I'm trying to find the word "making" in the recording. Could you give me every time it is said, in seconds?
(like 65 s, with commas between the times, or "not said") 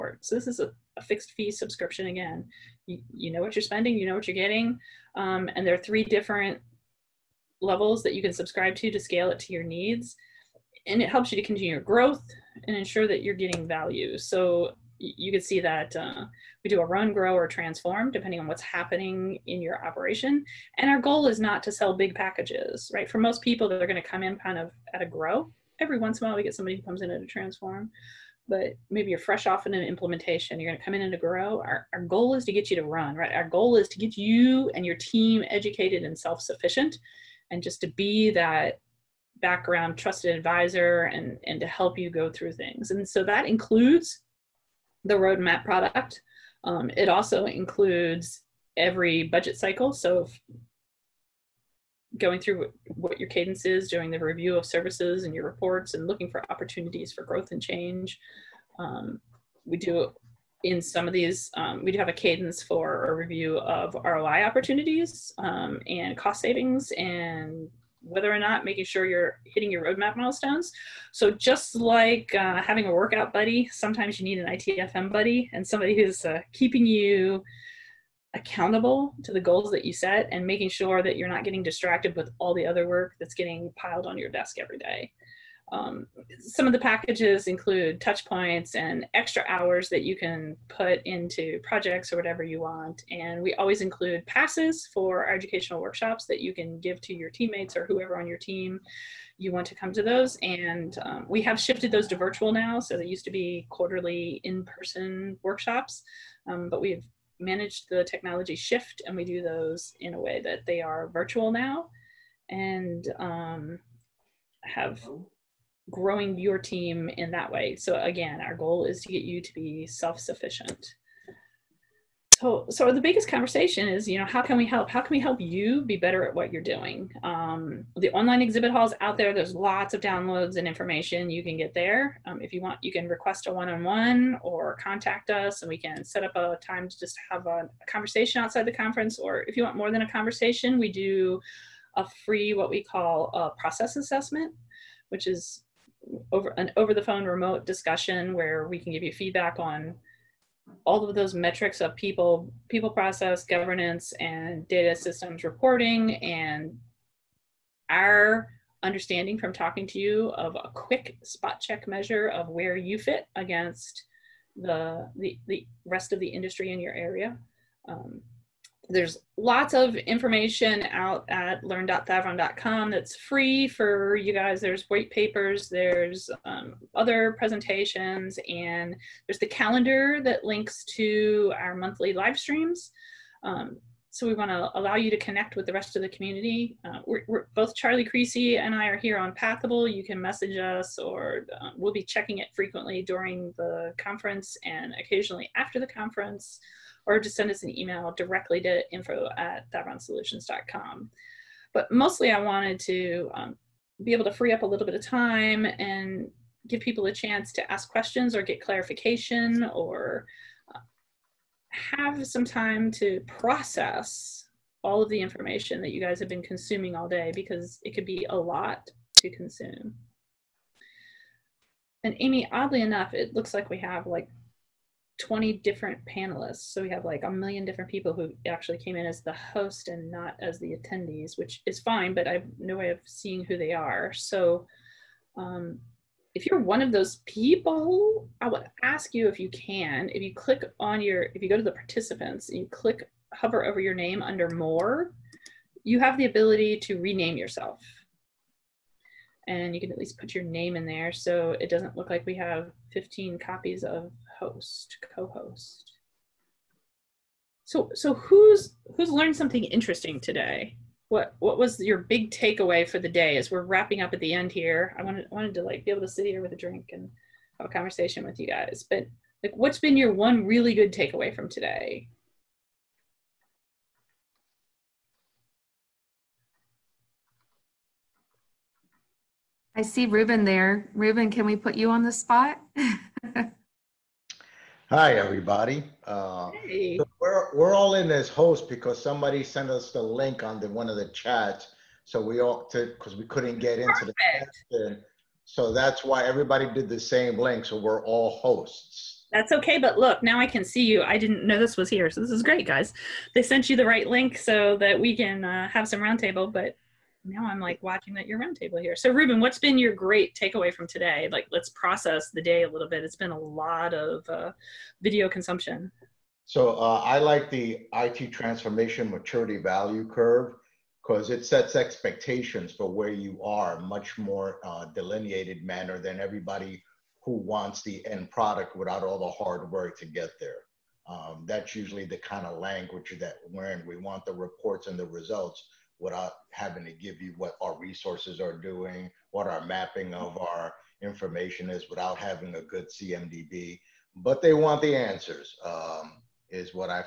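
68 s, 80 s.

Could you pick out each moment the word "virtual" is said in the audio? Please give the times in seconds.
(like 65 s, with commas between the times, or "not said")
102 s, 111 s.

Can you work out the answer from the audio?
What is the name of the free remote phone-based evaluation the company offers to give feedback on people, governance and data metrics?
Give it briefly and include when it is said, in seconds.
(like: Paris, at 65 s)
Process assessment, at 143 s.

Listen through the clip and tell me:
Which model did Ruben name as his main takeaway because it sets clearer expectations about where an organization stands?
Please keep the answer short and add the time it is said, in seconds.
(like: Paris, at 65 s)
IT transformation maturity value curve, at 317 s.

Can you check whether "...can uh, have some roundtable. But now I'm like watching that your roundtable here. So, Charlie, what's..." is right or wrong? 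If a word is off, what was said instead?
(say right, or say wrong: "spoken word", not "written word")
wrong: "Ruben", not "Charlie".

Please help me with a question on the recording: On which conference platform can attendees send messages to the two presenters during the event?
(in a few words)
Pathable.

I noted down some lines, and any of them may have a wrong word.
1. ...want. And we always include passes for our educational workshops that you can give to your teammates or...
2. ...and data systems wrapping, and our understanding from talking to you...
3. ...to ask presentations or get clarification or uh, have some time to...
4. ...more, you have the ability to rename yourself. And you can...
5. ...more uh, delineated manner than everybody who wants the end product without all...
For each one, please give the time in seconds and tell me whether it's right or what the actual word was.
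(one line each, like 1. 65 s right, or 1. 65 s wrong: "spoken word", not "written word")
1. 92 s right
2. 154 s wrong: "reporting", not "wrapping"
3. 207 s wrong: "questions", not "presentations"
4. 244 s right
5. 324 s right.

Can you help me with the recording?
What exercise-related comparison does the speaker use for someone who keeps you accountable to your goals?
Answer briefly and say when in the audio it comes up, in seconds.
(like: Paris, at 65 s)
Workout buddy, at 72 s.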